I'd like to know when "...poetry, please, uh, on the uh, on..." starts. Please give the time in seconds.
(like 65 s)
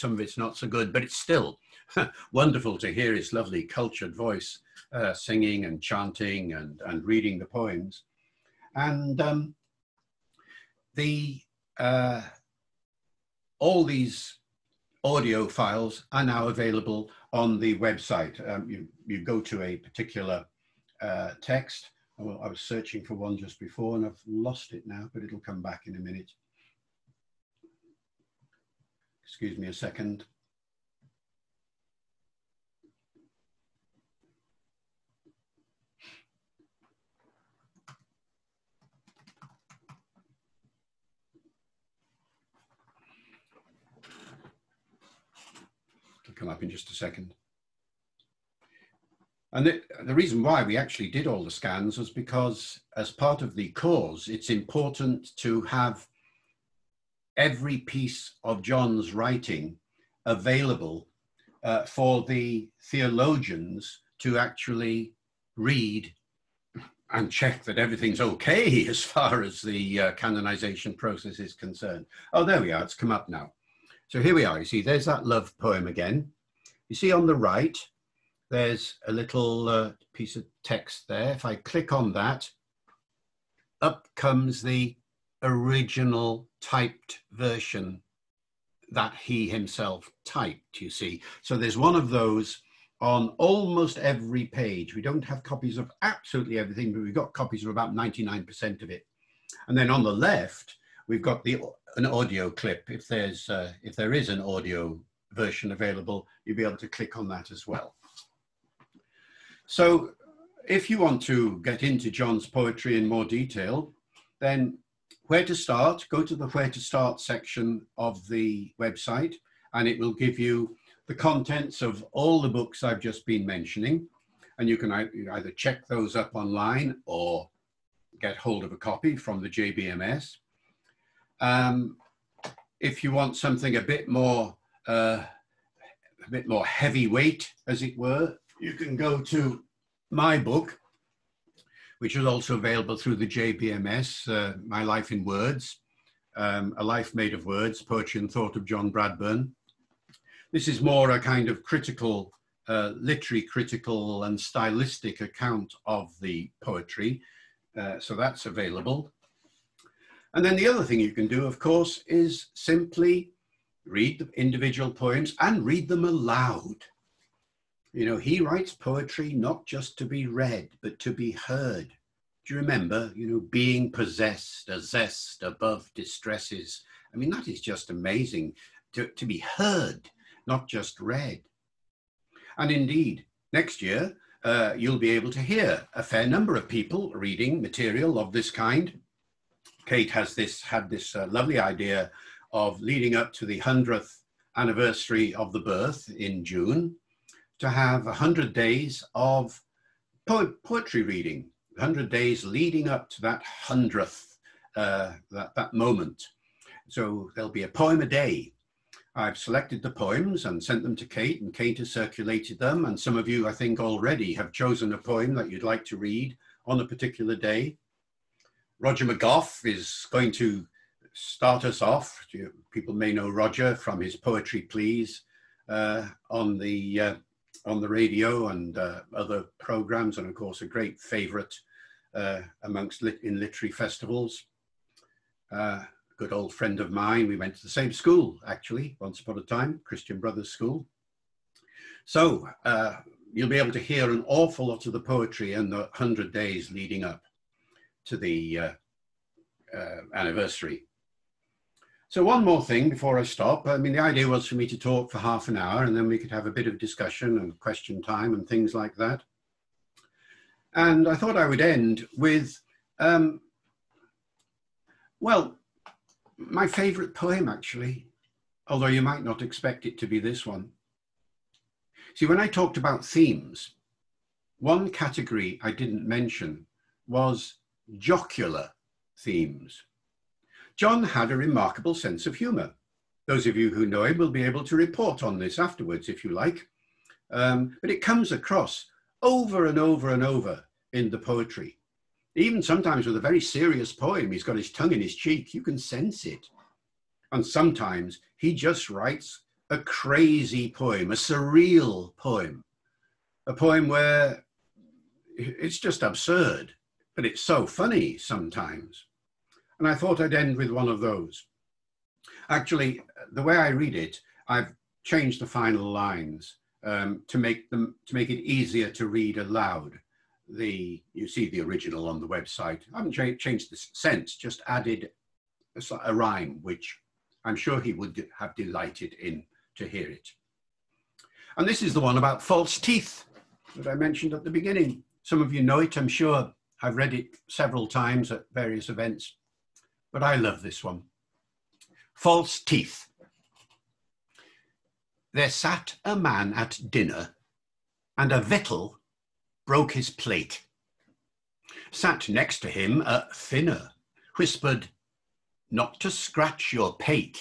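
224 s.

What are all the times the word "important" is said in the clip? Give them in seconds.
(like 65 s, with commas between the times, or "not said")
54 s.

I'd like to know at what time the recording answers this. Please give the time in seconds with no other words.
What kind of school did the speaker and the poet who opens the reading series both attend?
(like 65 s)
239 s.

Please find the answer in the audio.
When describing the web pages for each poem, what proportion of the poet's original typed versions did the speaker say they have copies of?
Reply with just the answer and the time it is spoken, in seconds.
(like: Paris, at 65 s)
99%, at 97 s.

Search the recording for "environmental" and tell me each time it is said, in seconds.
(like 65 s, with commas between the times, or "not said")
not said.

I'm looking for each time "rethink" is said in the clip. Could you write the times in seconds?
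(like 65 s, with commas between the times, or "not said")
not said.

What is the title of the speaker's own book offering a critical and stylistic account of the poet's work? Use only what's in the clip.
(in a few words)
A Life Made of Words.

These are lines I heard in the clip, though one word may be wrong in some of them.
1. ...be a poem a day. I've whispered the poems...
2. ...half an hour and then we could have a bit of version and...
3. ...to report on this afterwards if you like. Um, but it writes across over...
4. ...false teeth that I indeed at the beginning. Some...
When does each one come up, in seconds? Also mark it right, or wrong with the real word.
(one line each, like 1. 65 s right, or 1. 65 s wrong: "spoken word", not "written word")
1. 207 s wrong: "selected", not "whispered"
2. 255 s wrong: "discussion", not "version"
3. 284 s wrong: "comes", not "writes"
4. 332 s wrong: "mentioned", not "indeed".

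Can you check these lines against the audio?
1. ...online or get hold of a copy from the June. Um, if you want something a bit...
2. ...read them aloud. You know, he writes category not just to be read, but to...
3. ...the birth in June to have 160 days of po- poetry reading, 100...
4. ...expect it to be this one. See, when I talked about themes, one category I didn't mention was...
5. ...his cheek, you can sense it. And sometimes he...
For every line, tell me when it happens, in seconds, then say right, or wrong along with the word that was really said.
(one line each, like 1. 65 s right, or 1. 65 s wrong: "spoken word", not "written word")
1. 126 s wrong: "JBMS", not "June"
2. 165 s wrong: "poetry", not "category"
3. 195 s wrong: "100", not "160"
4. 269 s right
5. 295 s right.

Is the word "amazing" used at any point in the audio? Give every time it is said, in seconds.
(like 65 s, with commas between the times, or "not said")
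177 s.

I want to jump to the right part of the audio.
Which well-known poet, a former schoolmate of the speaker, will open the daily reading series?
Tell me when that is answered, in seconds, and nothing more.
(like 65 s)
218 s.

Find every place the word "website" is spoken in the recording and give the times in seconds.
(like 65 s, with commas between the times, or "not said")
17 s, 118 s, 322 s.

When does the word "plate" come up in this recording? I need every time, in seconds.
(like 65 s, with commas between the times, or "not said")
350 s.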